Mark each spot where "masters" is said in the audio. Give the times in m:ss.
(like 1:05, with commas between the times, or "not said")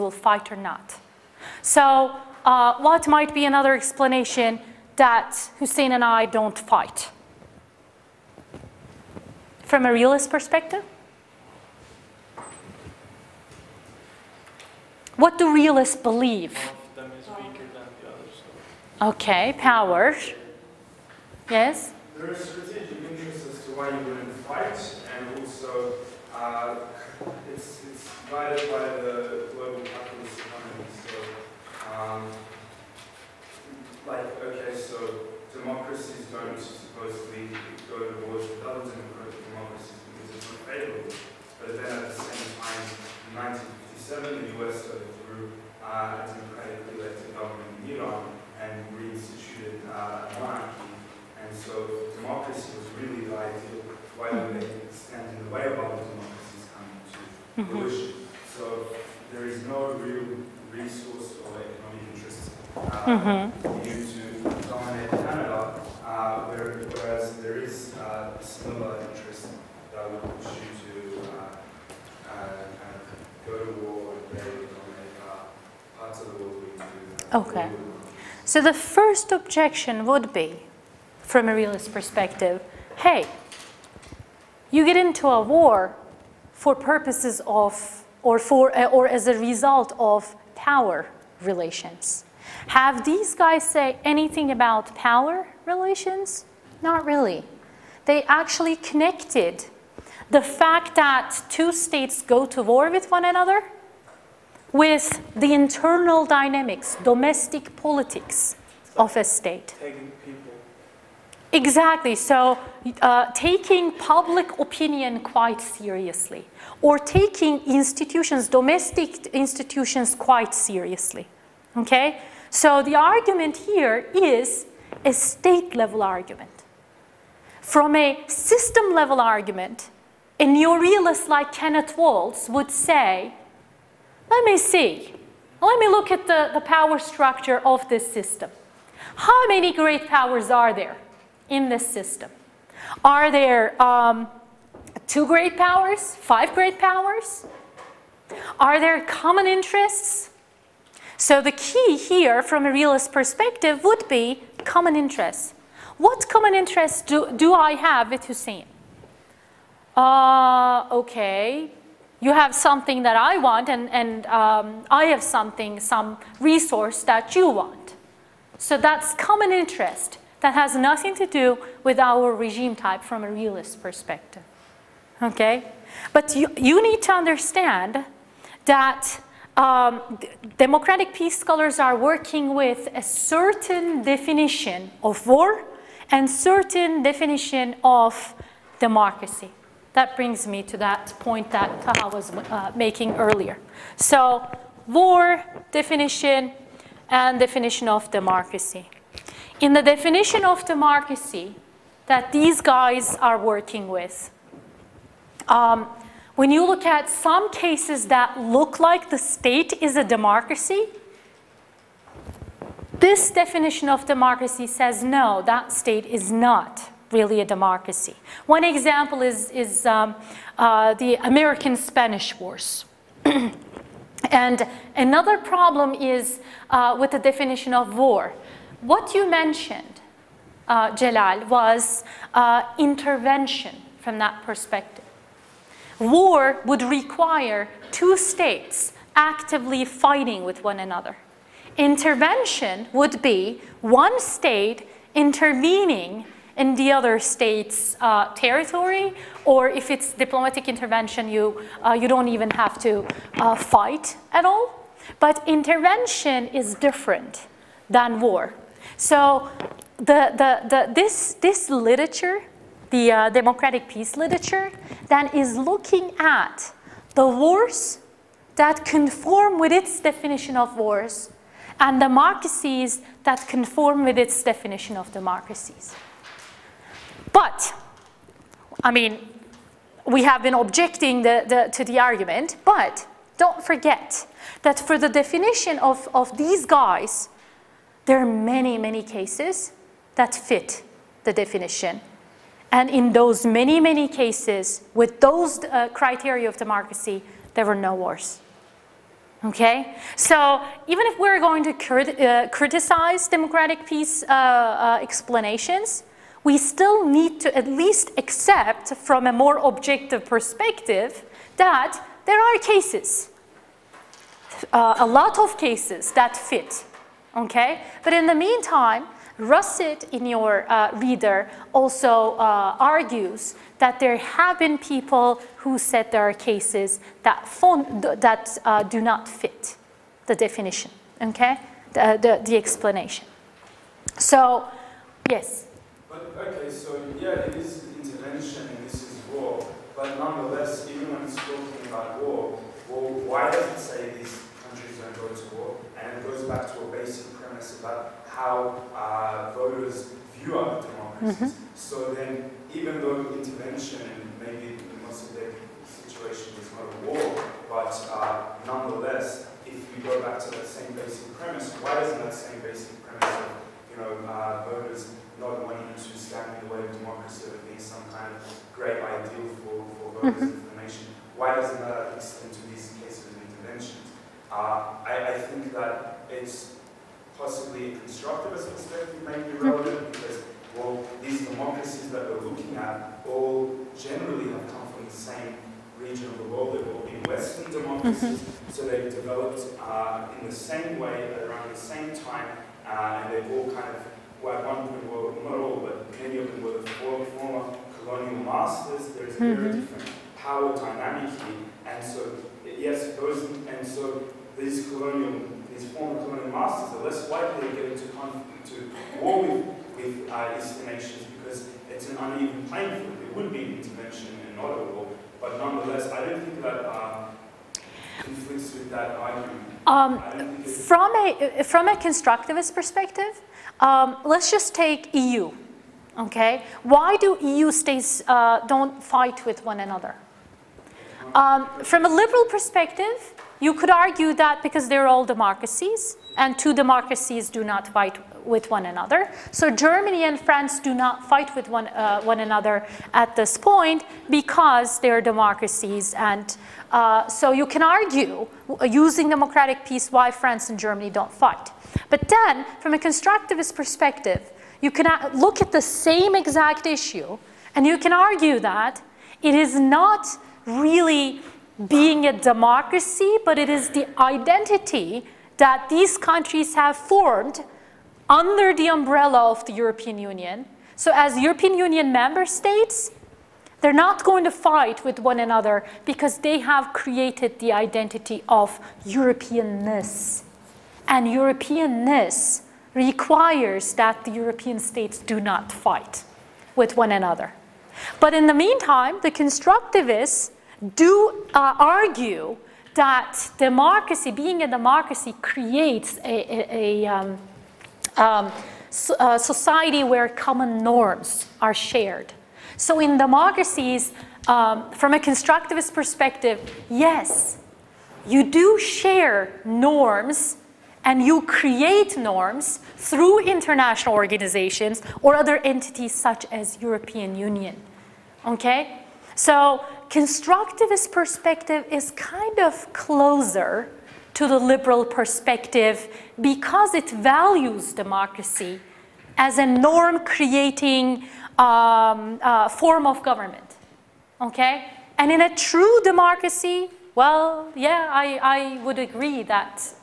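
6:38, 6:46.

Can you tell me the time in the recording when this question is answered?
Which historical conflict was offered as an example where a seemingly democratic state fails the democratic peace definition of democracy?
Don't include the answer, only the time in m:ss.
3:41.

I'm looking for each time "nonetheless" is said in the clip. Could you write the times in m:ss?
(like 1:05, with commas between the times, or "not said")
5:40, 5:58, 6:55.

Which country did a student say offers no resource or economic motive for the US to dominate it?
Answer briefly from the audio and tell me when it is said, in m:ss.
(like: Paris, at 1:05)
Canada, at 1:05.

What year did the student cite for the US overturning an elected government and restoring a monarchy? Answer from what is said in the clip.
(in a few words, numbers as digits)
1957.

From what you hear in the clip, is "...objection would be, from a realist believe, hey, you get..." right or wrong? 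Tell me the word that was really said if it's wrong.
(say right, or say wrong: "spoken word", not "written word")
wrong: "perspective", not "believe".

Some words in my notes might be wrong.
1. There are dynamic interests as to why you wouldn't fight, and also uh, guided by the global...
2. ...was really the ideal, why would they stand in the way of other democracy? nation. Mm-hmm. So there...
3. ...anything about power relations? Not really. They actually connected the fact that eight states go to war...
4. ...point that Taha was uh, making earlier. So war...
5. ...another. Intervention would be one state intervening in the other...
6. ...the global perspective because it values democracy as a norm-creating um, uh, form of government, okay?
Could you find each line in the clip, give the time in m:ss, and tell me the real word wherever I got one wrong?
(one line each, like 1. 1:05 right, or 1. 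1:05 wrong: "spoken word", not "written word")
1. 0:22 wrong: "strategic", not "dynamic"
2. 0:52 wrong: "pollution", not "nation"
3. 1:34 wrong: "two", not "eight"
4. 3:11 right
5. 4:00 right
6. 8:44 wrong: "liberal", not "global".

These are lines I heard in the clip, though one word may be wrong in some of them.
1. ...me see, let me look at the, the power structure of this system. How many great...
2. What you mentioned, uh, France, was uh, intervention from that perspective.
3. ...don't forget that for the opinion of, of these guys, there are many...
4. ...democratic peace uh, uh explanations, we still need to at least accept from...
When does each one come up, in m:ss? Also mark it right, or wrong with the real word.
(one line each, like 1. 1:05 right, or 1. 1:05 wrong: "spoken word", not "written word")
1. 2:14 right
2. 3:48 wrong: "Jalal", not "France"
3. 4:43 wrong: "definition", not "opinion"
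4. 5:03 right.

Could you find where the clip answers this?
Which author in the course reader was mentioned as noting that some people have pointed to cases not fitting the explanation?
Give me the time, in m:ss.
5:19.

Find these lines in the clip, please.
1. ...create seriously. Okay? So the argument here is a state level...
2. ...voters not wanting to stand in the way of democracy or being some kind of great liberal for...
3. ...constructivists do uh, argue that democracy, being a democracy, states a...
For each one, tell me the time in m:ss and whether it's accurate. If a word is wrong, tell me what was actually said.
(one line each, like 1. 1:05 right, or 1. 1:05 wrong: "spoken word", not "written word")
1. 2:00 wrong: "quite", not "create"
2. 6:04 wrong: "ideal", not "liberal"
3. 8:09 wrong: "creates", not "states".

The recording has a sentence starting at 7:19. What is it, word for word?
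So Germany and France do not fight with one, uh, one another at this point because they're democracies.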